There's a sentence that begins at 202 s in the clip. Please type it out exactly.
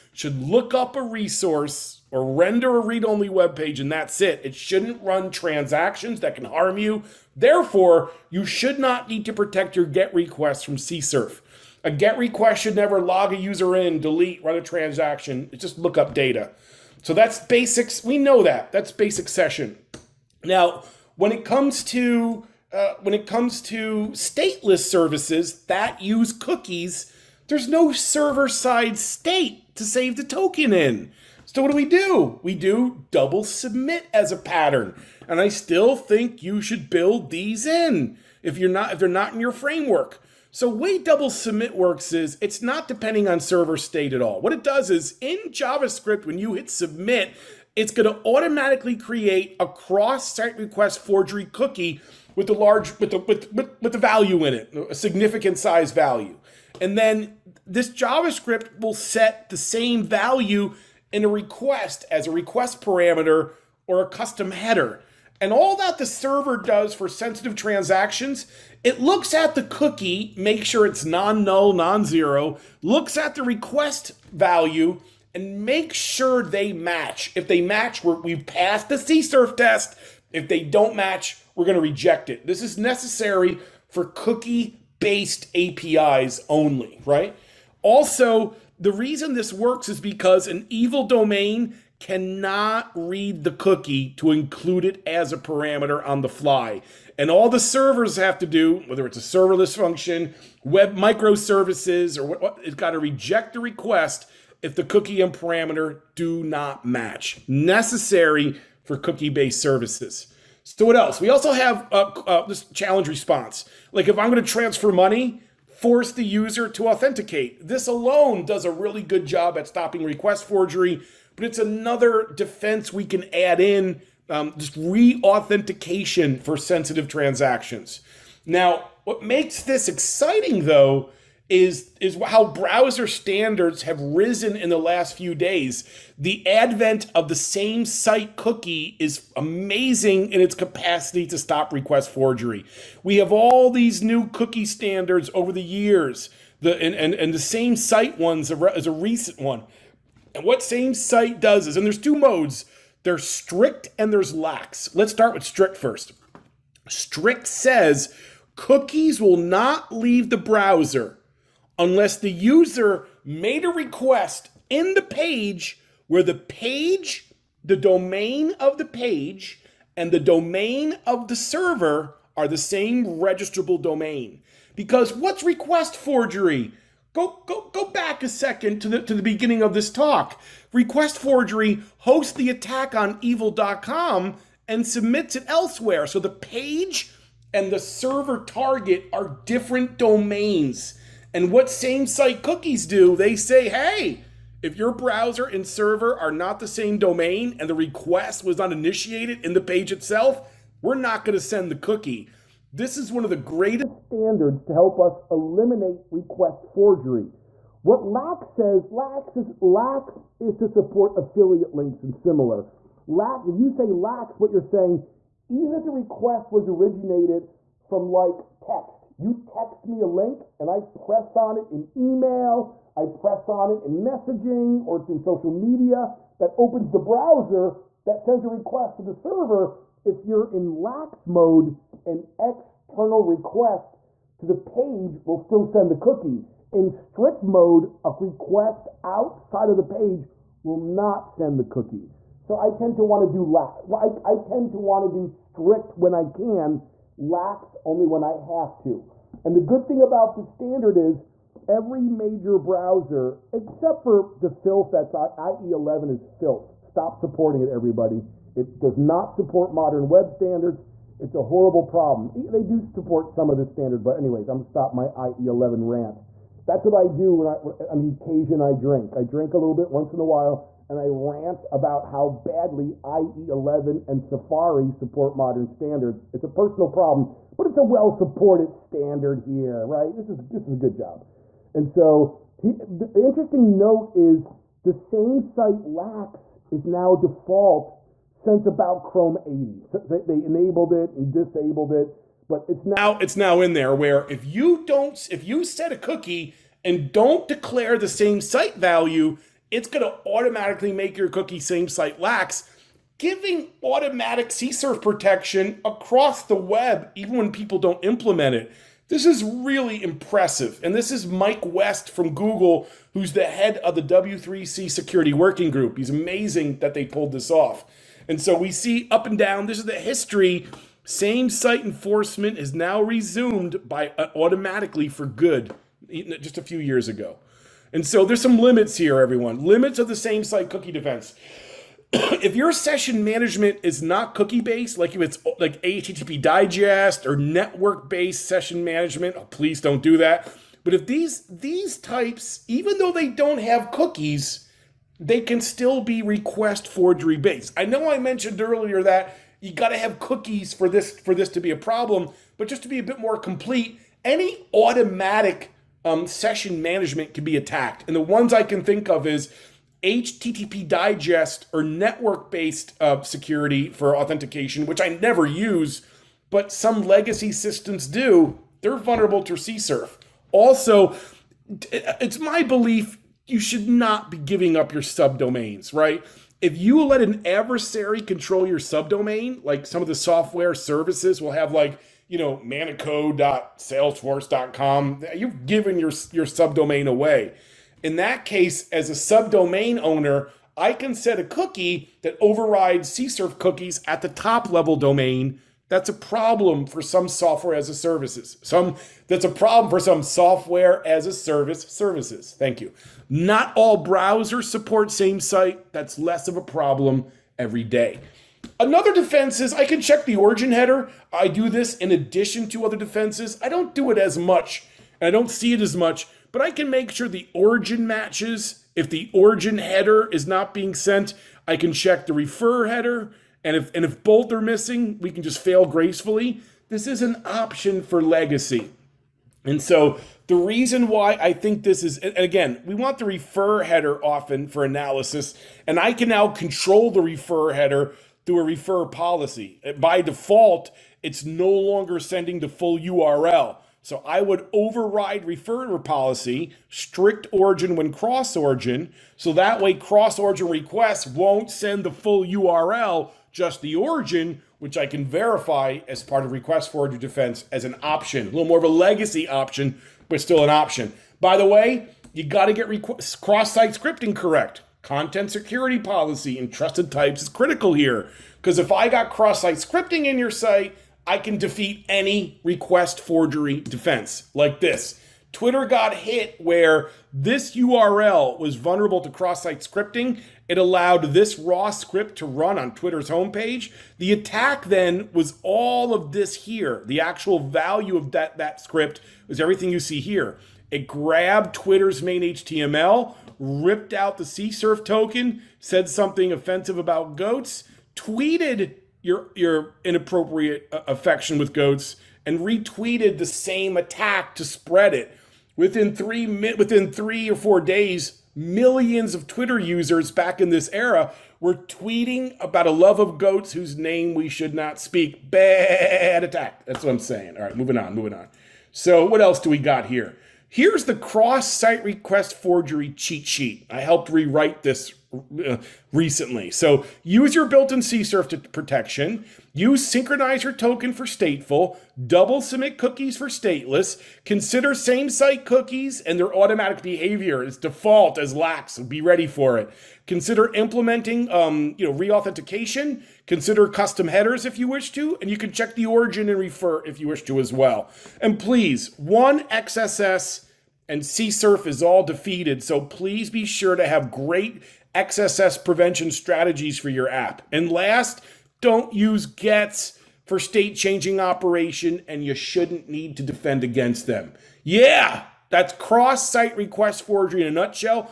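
This is one of the greatest standards to help us eliminate request forgery.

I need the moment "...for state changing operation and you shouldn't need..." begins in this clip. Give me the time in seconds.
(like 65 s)
560 s.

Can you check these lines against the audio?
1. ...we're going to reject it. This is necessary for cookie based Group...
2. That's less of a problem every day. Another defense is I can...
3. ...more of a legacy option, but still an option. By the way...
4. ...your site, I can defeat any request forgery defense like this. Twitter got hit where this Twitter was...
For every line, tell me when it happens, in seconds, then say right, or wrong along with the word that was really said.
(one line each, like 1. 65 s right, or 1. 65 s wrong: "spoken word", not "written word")
1. 81 s wrong: "APIs", not "Group"
2. 405 s right
3. 458 s right
4. 470 s wrong: "URL", not "Twitter".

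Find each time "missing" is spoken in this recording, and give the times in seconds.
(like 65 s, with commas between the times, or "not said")
424 s.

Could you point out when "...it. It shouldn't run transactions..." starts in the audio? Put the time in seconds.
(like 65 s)
4 s.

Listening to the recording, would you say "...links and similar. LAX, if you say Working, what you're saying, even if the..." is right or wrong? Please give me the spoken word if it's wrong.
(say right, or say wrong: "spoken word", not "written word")
wrong: "LAX", not "Working".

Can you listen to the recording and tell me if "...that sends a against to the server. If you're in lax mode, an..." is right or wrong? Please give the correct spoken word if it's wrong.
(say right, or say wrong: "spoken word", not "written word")
wrong: "request", not "against".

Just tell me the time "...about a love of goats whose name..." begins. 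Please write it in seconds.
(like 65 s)
512 s.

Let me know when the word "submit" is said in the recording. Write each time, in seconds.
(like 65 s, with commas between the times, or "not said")
33 s, 41 s, 46 s, 184 s, 532 s.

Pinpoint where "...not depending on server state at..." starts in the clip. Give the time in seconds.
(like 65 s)
42 s.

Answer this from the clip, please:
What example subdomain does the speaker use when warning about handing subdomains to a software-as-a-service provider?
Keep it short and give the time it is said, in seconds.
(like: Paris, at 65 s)
manico.salesforce.com, at 382 s.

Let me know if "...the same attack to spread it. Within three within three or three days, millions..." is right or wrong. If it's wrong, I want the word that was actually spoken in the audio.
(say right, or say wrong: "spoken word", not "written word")
wrong: "four", not "three".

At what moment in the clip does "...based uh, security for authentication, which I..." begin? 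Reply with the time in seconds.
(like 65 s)
362 s.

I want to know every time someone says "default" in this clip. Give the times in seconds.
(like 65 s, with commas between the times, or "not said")
287 s, 440 s, 537 s.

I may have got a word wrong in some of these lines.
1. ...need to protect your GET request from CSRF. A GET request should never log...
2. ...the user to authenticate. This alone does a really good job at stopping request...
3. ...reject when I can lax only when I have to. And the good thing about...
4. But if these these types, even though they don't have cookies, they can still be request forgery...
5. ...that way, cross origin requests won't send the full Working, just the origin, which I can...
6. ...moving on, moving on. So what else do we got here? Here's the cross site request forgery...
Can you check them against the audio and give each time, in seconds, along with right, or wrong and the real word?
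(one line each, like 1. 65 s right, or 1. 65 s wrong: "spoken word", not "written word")
1. 9 s right
2. 116 s right
3. 245 s wrong: "strict", not "reject"
4. 340 s right
5. 449 s wrong: "URL", not "Working"
6. 517 s right.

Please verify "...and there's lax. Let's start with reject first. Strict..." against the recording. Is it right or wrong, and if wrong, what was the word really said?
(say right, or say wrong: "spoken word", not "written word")
wrong: "strict", not "reject".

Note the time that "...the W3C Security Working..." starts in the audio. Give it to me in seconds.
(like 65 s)
313 s.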